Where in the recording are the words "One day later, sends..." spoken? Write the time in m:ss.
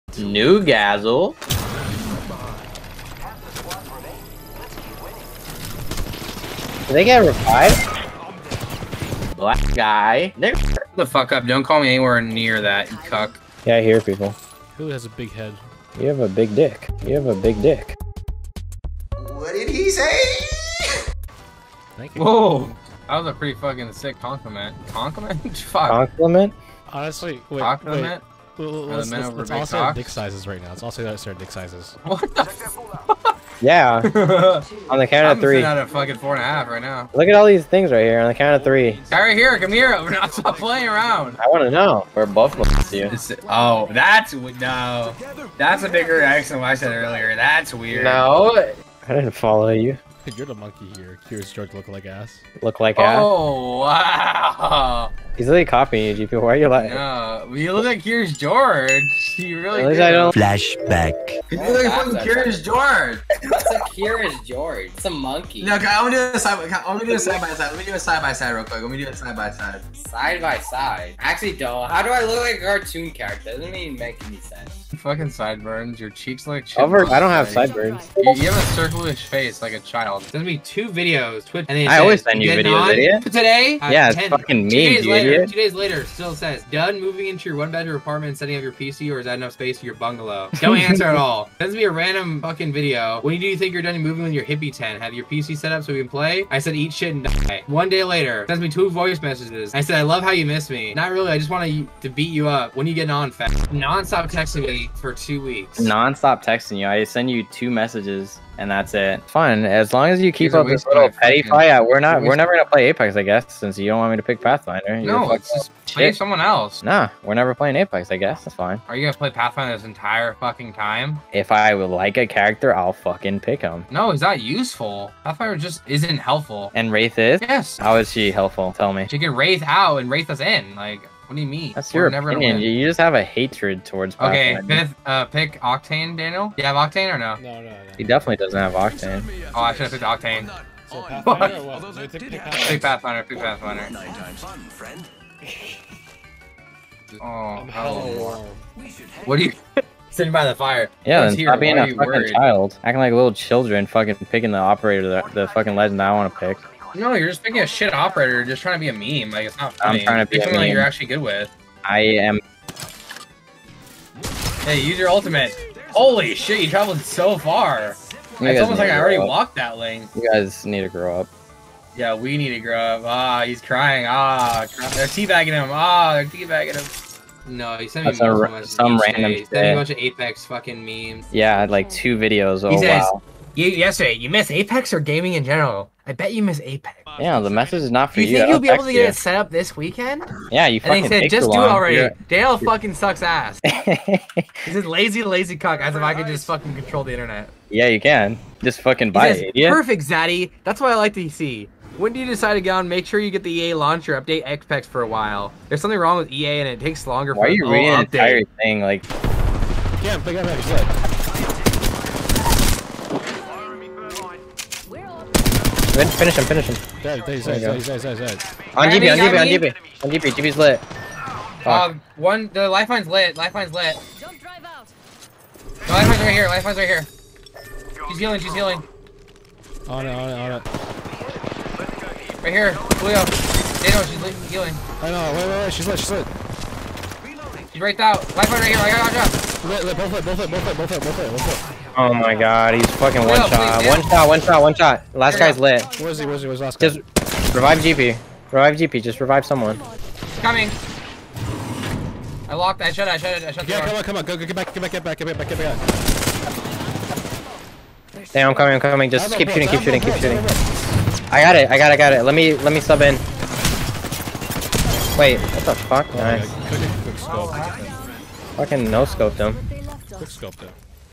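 1:37.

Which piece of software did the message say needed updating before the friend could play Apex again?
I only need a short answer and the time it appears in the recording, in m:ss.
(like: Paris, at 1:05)
EA launcher, at 3:23.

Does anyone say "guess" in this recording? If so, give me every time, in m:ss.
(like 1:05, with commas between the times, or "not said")
1:53, 1:58.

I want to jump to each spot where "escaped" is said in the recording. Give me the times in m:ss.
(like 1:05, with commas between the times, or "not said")
not said.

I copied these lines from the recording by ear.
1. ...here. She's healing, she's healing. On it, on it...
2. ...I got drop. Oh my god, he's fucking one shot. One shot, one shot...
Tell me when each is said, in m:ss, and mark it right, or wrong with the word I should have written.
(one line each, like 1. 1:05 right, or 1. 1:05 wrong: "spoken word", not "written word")
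1. 3:46 right
2. 3:58 right.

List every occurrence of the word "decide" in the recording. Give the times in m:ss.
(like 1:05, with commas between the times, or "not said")
3:22.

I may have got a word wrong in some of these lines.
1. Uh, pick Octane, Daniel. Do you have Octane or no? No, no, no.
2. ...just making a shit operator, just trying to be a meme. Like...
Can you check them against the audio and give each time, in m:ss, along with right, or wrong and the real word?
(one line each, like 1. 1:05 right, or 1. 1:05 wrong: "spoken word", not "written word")
1. 2:15 right
2. 2:37 right.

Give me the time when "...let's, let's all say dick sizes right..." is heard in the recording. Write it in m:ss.
0:29.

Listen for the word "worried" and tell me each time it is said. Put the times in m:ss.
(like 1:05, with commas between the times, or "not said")
2:31.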